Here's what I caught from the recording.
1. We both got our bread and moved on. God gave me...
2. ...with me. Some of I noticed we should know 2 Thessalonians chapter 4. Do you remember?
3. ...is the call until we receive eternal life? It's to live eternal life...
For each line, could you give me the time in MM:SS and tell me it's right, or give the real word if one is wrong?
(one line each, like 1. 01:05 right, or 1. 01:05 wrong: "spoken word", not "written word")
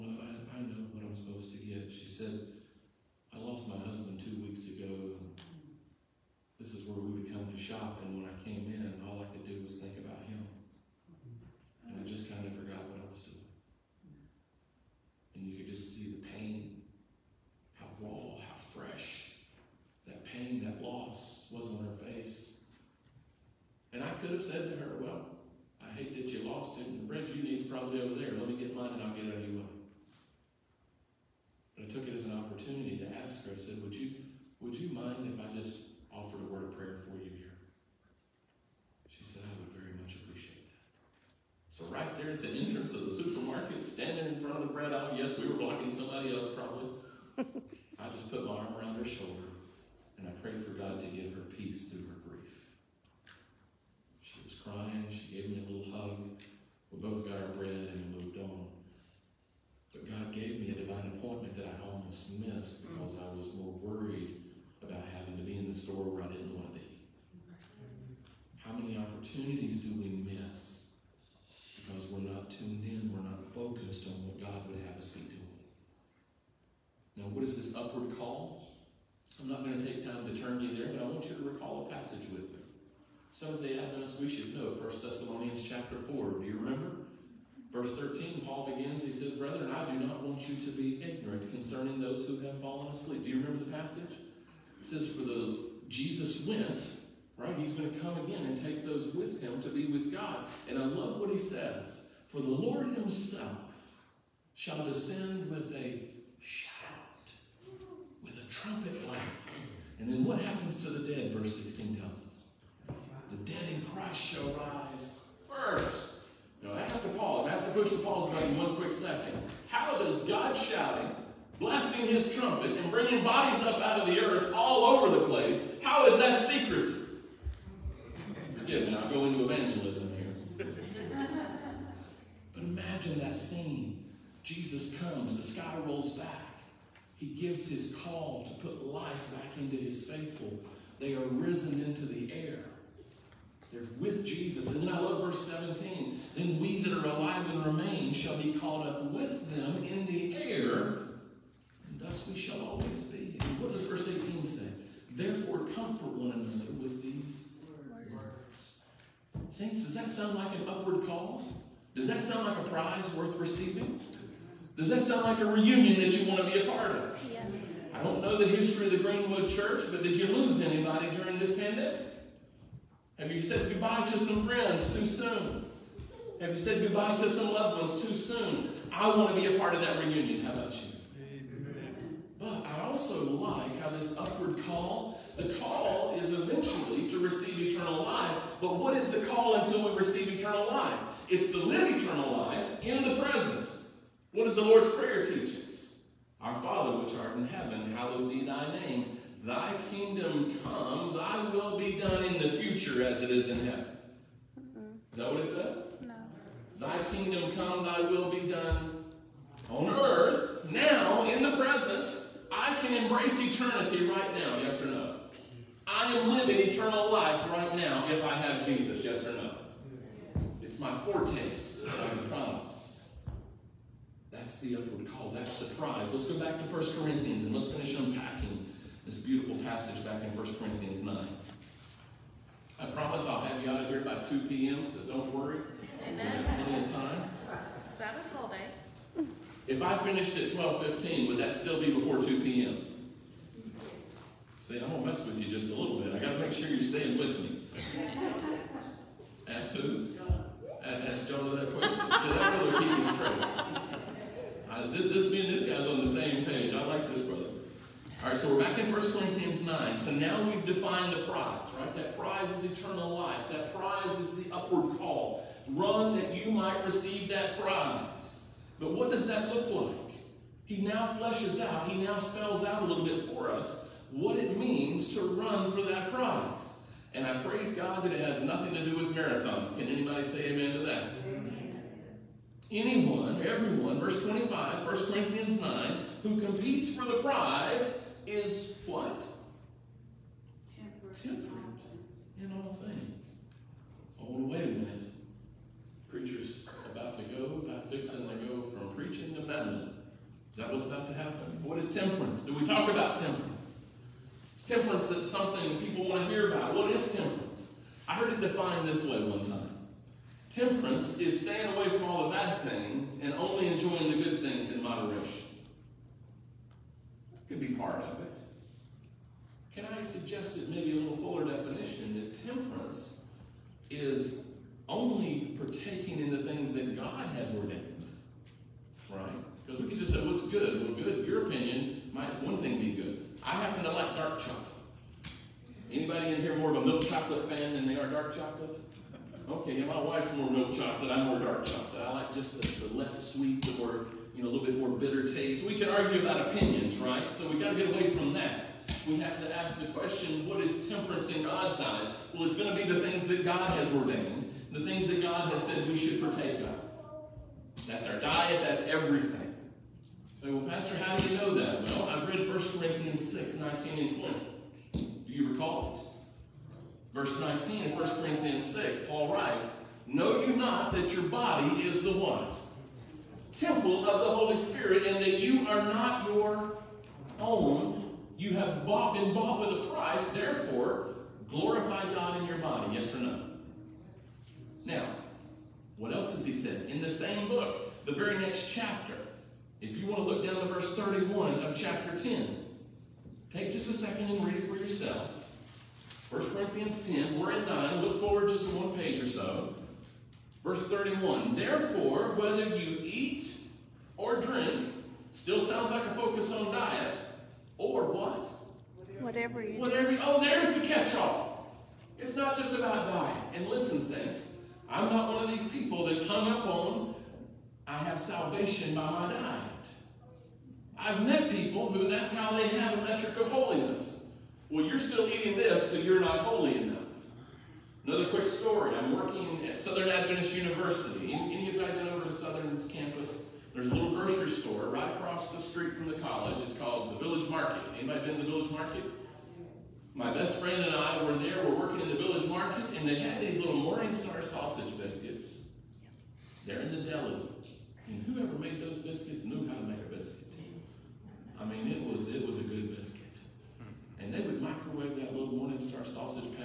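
1. 00:56 right
2. 01:22 wrong: "1", not "2"
3. 03:08 right.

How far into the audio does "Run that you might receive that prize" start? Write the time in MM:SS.
04:25.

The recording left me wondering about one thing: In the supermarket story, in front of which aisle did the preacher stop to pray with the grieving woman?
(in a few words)
bread aisle.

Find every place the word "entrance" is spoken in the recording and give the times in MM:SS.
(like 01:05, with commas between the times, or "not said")
00:42.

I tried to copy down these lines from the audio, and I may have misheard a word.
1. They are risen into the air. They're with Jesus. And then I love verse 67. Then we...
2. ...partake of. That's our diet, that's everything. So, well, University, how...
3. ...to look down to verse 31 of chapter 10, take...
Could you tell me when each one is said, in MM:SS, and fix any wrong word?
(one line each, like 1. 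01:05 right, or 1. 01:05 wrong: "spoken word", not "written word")
1. 02:20 wrong: "17", not "67"
2. 05:56 wrong: "Pastor", not "University"
3. 06:30 right.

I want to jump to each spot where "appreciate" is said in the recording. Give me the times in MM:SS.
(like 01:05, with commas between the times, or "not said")
00:40.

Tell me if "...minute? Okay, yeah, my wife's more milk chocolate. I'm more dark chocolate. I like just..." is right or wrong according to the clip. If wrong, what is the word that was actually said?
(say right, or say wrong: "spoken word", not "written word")
wrong: "chocolate", not "minute".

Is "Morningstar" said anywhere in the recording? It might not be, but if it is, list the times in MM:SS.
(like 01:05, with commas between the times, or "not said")
07:23, 07:35.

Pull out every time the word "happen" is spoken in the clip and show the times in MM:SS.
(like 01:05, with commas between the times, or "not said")
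01:50, 05:01, 05:33.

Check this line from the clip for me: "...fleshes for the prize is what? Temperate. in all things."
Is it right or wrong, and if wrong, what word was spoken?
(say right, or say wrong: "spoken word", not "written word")
wrong: "competes", not "fleshes".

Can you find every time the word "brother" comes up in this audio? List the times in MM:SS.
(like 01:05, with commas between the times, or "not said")
04:12, 04:17.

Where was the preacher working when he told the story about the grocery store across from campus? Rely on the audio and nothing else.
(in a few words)
Southern Adventist University.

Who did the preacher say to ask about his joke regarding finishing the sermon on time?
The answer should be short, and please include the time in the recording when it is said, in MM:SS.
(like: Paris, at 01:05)
Jonah, at 04:11.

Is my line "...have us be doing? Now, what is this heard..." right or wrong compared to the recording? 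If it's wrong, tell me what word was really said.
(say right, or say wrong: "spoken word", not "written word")
wrong: "upward", not "heard".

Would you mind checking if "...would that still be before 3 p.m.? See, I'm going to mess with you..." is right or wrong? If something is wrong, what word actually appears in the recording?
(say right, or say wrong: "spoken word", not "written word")
wrong: "2", not "3".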